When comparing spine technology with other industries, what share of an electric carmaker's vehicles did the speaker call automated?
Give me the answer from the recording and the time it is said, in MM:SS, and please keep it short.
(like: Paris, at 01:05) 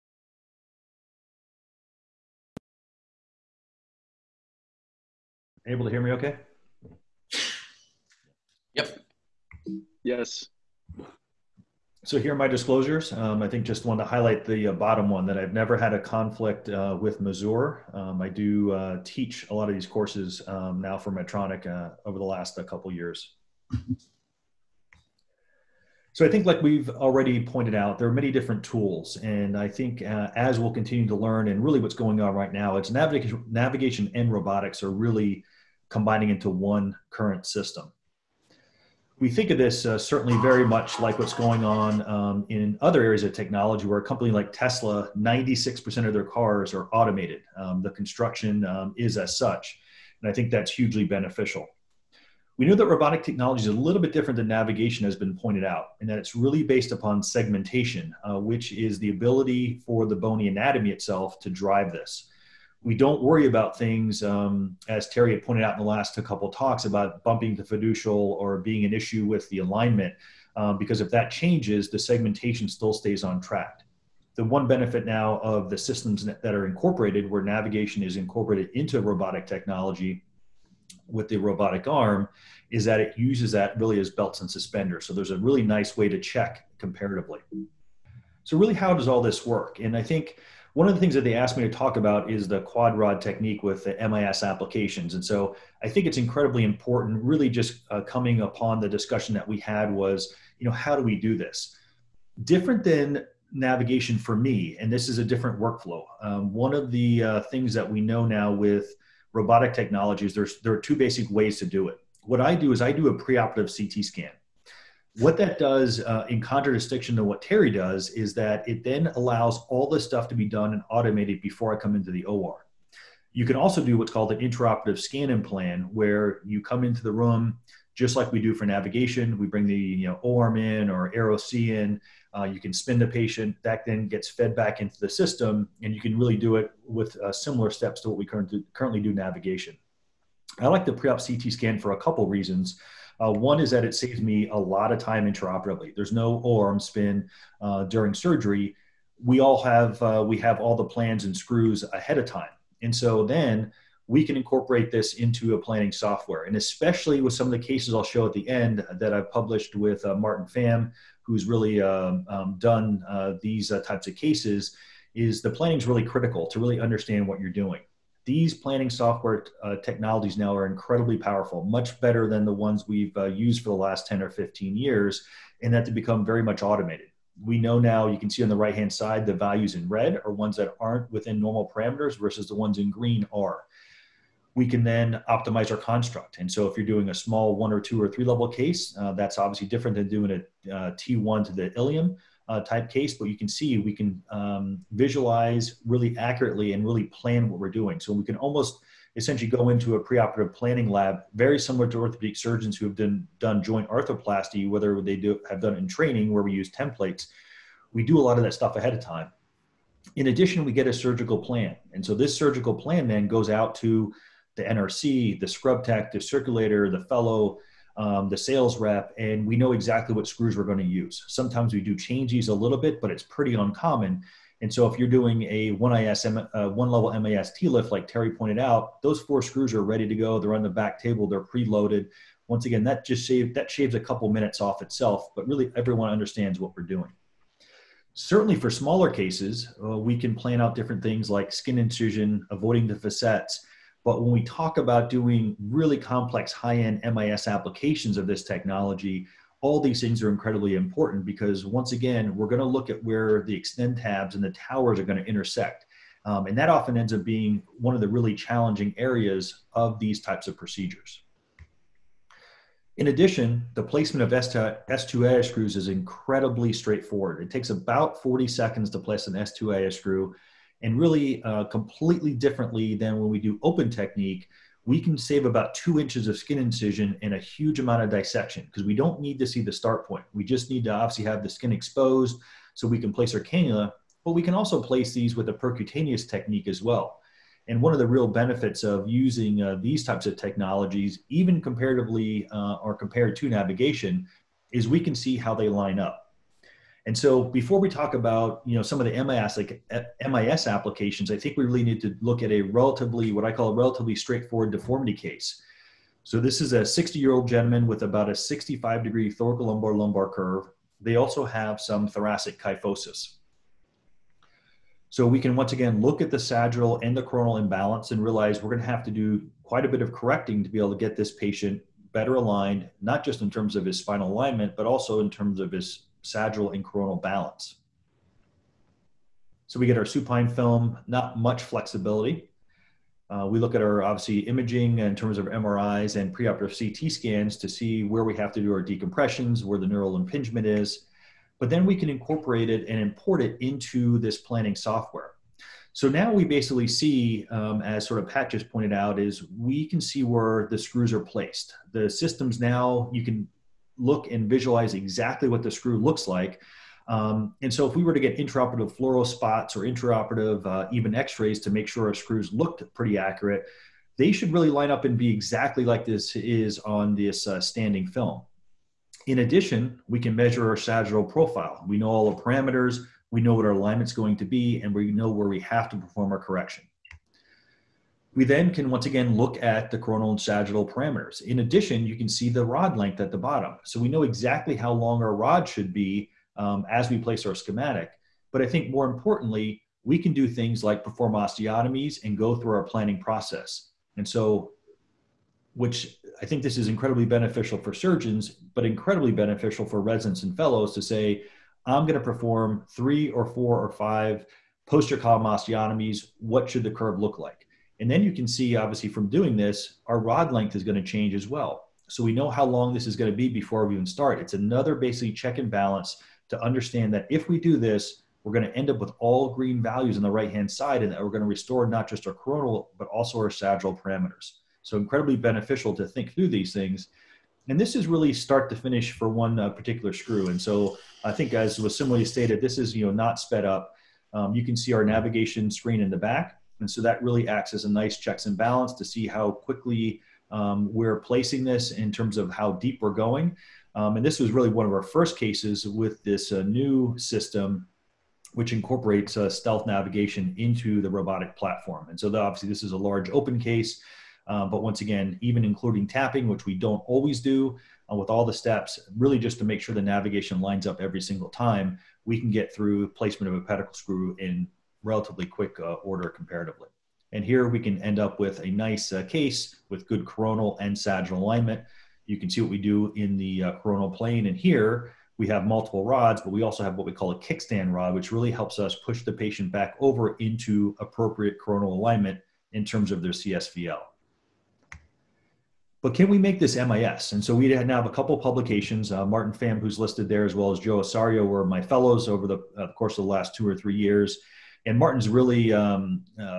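96%, at 00:45.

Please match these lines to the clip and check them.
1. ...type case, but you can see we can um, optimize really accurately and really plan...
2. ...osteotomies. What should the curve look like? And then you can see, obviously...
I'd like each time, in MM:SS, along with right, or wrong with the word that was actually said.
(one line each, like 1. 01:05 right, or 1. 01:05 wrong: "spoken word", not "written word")
1. 03:12 wrong: "visualize", not "optimize"
2. 06:45 right.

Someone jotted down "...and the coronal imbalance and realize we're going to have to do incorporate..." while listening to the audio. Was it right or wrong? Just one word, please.
wrong.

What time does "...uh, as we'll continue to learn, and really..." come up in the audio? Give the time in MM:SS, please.
00:30.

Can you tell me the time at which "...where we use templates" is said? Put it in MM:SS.
03:26.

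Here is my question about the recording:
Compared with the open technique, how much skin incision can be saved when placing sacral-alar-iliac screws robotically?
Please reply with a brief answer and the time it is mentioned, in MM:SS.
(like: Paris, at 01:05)
about two inches, at 04:35.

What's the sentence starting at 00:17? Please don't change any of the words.
Um, I do uh, teach a lot of these courses um, now for Medtronic uh, over the last uh, couple years.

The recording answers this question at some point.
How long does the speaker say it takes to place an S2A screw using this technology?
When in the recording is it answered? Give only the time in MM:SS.
04:27.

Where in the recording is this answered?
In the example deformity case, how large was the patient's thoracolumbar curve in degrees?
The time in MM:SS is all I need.
05:08.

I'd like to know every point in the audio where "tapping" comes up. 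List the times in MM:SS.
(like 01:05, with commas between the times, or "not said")
07:36.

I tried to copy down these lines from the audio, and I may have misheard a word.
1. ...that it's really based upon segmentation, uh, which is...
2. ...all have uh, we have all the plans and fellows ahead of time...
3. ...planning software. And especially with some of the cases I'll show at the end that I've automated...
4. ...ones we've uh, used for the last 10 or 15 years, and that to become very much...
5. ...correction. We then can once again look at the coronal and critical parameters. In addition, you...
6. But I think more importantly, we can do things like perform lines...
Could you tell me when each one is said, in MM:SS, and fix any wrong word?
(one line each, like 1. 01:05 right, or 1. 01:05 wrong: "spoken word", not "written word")
1. 00:56 right
2. 02:29 wrong: "screws", not "fellows"
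3. 02:35 wrong: "published", not "automated"
4. 02:52 right
5. 06:16 wrong: "sagittal", not "critical"
6. 06:28 wrong: "osteotomies", not "lines".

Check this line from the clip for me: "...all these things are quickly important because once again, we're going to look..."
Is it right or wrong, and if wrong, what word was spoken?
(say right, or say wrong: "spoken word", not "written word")
wrong: "incredibly", not "quickly".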